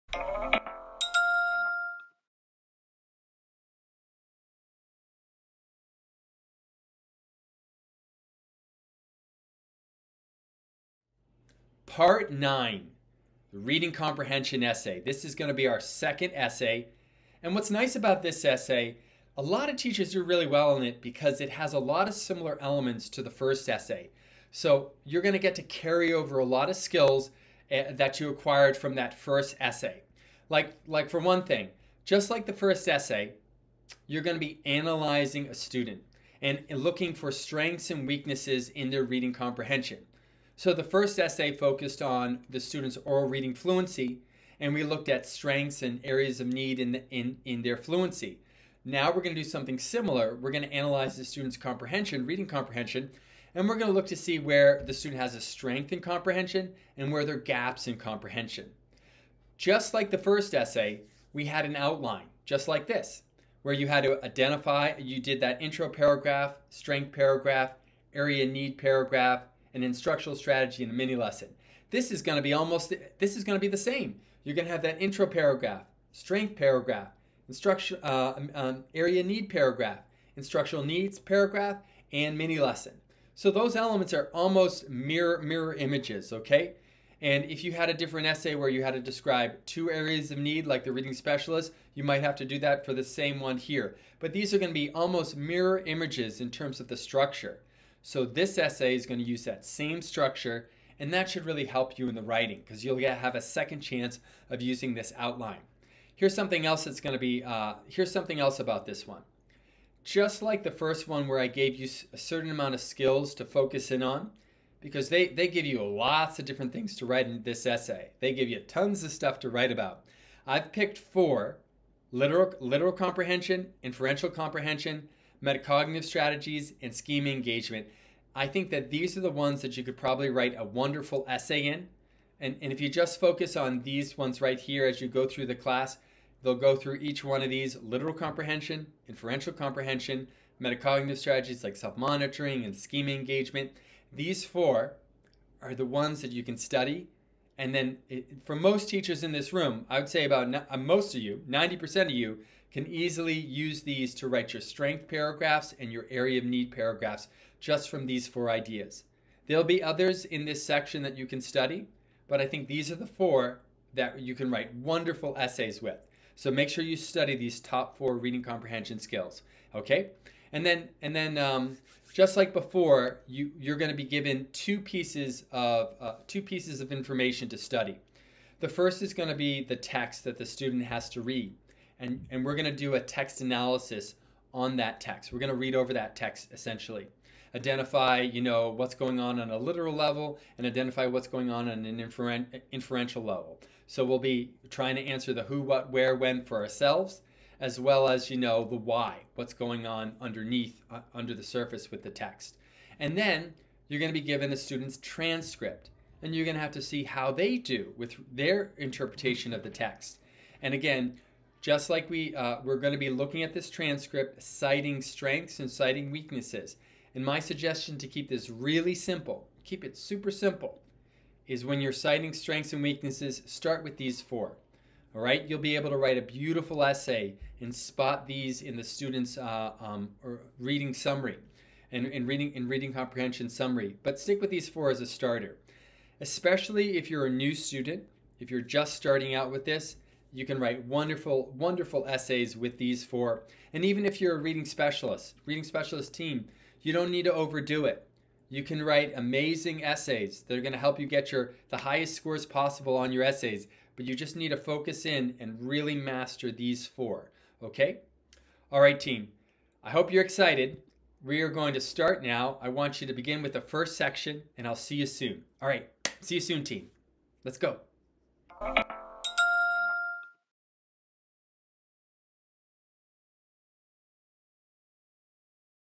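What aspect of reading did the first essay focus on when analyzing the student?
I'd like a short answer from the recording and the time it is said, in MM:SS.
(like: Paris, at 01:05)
oral reading fluency, at 00:43.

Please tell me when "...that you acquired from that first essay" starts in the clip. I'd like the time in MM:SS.
00:27.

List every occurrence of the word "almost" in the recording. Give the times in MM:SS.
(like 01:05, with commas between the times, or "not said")
01:12, 01:24, 01:34.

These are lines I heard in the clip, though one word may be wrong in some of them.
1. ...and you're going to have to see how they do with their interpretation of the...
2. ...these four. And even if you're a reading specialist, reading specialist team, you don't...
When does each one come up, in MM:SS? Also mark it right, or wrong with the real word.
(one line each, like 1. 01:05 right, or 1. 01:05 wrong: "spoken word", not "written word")
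1. 03:26 right
2. 04:02 right.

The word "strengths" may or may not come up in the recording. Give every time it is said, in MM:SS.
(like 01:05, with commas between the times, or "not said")
00:37, 00:45, 00:55, 01:06, 01:16, 02:34, 03:34, 03:42.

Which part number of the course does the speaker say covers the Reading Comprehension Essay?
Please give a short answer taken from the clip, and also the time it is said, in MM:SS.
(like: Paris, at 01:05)
Part 9, at 00:11.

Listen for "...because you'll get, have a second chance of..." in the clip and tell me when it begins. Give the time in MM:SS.
01:42.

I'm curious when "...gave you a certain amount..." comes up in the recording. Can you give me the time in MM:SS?
01:51.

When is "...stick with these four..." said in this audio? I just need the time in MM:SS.
03:54.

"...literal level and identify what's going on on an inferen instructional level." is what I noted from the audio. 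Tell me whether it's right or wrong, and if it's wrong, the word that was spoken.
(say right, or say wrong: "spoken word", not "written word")
wrong: "inferential", not "instructional".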